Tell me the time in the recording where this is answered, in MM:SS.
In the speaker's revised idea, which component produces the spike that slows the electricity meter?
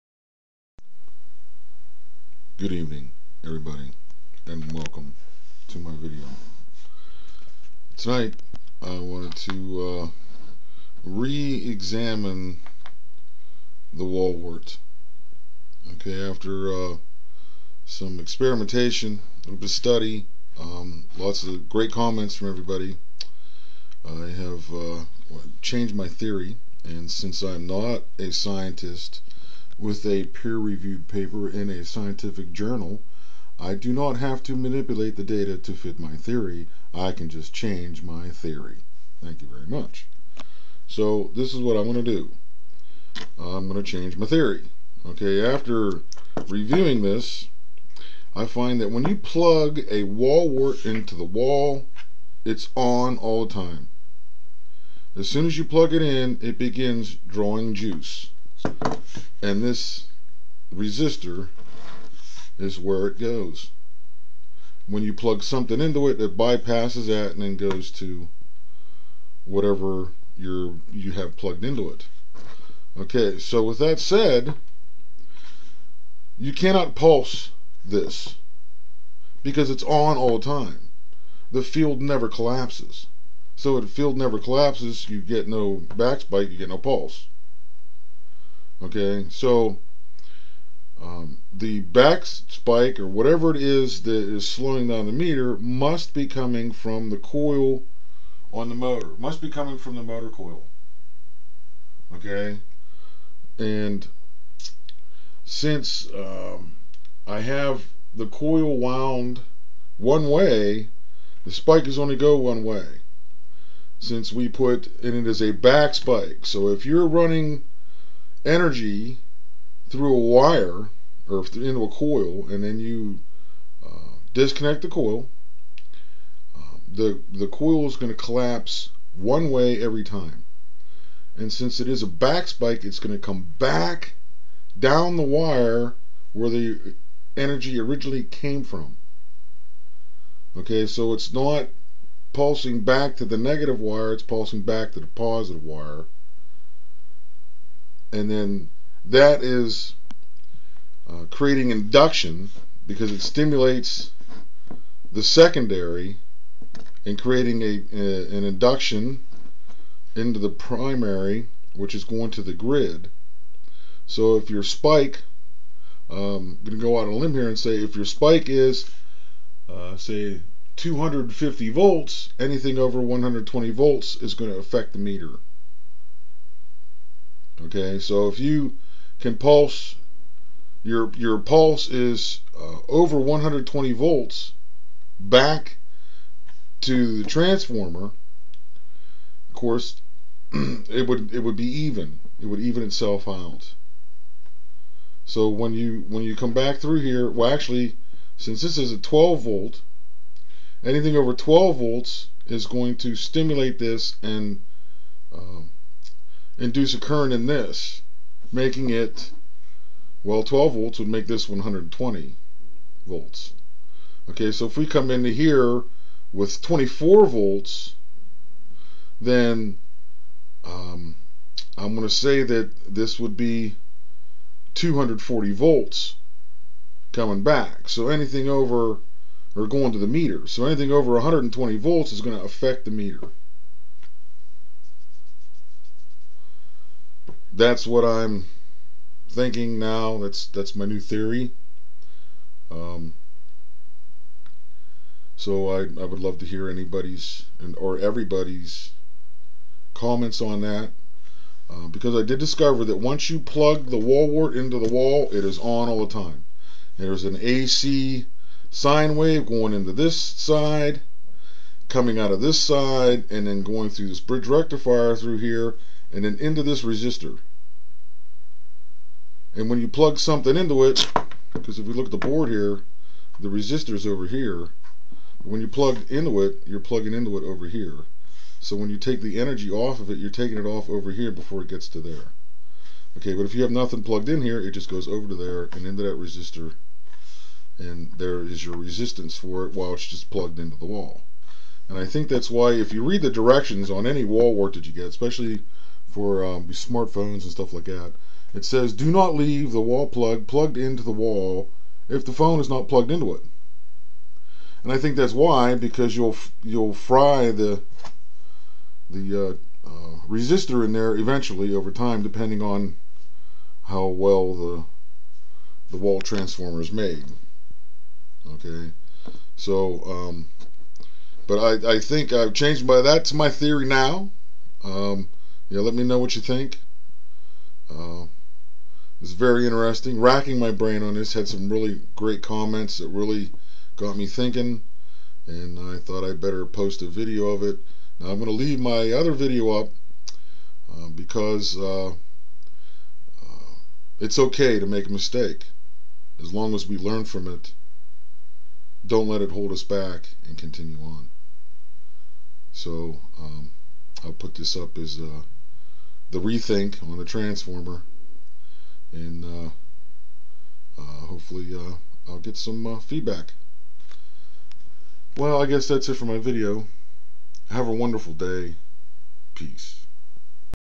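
01:40.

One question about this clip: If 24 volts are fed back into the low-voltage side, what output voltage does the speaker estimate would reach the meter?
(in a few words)
240 volts.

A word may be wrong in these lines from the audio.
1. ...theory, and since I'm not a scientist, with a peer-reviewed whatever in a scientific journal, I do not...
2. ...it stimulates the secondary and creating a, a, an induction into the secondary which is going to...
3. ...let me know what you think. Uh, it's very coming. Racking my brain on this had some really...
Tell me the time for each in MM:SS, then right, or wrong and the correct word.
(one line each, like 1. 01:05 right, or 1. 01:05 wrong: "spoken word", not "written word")
1. 00:26 wrong: "paper", not "whatever"
2. 02:33 wrong: "primary", not "secondary"
3. 05:25 wrong: "interesting", not "coming".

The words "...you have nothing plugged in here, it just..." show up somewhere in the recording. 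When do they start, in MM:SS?
04:43.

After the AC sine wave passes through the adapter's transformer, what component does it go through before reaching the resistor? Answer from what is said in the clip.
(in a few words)
bridge rectifier.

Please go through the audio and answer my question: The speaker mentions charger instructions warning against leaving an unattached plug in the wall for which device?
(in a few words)
smartphones.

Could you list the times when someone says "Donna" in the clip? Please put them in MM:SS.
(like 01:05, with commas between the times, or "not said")
not said.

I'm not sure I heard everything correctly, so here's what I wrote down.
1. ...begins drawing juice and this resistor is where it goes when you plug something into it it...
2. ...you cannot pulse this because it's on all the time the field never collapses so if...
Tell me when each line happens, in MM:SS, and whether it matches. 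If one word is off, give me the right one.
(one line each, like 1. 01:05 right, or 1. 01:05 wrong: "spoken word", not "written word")
1. 00:56 right
2. 01:16 right.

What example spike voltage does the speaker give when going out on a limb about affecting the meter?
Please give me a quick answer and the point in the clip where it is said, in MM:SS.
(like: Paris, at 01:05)
250 volts, at 02:50.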